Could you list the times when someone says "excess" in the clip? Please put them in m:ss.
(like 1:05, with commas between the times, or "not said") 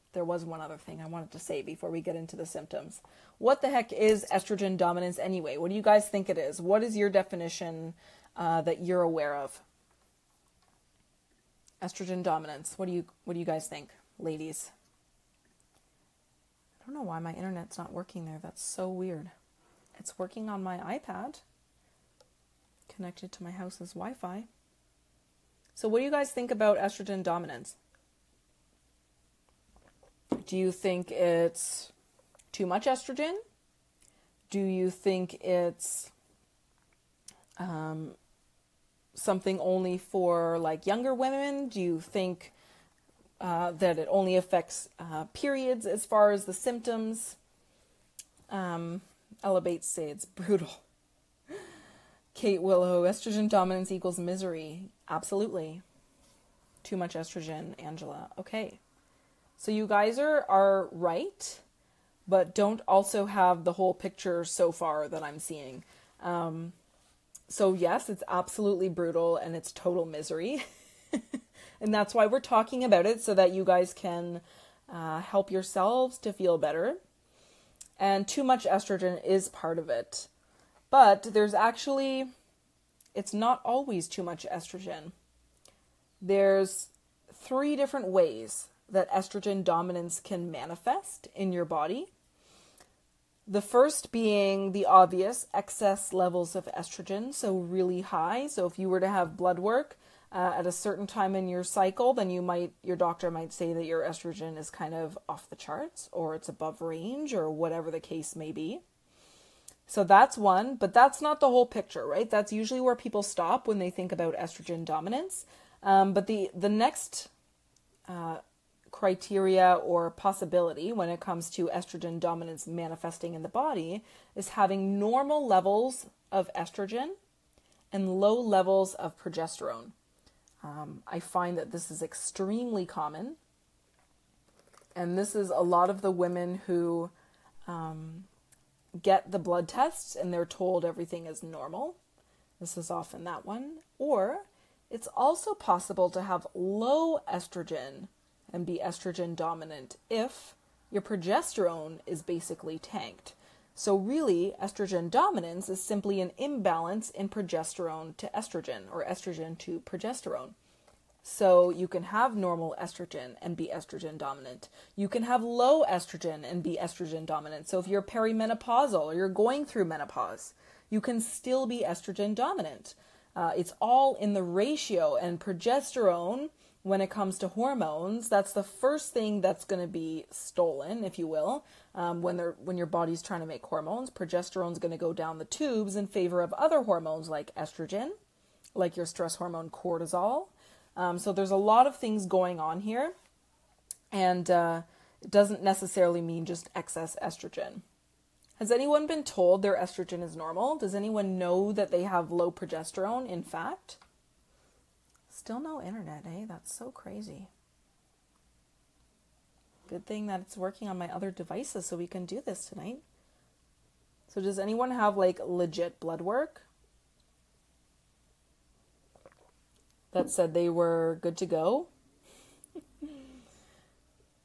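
1:35, 3:16.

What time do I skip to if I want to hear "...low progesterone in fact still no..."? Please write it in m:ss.
3:22.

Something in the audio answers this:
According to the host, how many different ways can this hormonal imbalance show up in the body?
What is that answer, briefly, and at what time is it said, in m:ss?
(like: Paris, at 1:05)
3, at 1:27.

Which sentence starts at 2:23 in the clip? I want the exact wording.
Or it's also possible to have low estrogen and be estrogen dominant if your progesterone is basically tanked.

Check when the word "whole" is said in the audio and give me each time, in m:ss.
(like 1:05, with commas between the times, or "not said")
1:03, 1:51.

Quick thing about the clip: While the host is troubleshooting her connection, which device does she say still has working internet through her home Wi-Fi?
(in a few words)
iPad.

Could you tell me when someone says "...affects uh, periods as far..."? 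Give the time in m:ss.
0:44.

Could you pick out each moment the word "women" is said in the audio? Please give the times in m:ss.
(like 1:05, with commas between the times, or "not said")
0:41, 2:16.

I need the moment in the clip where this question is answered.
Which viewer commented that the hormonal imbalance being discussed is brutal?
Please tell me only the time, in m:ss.
0:49.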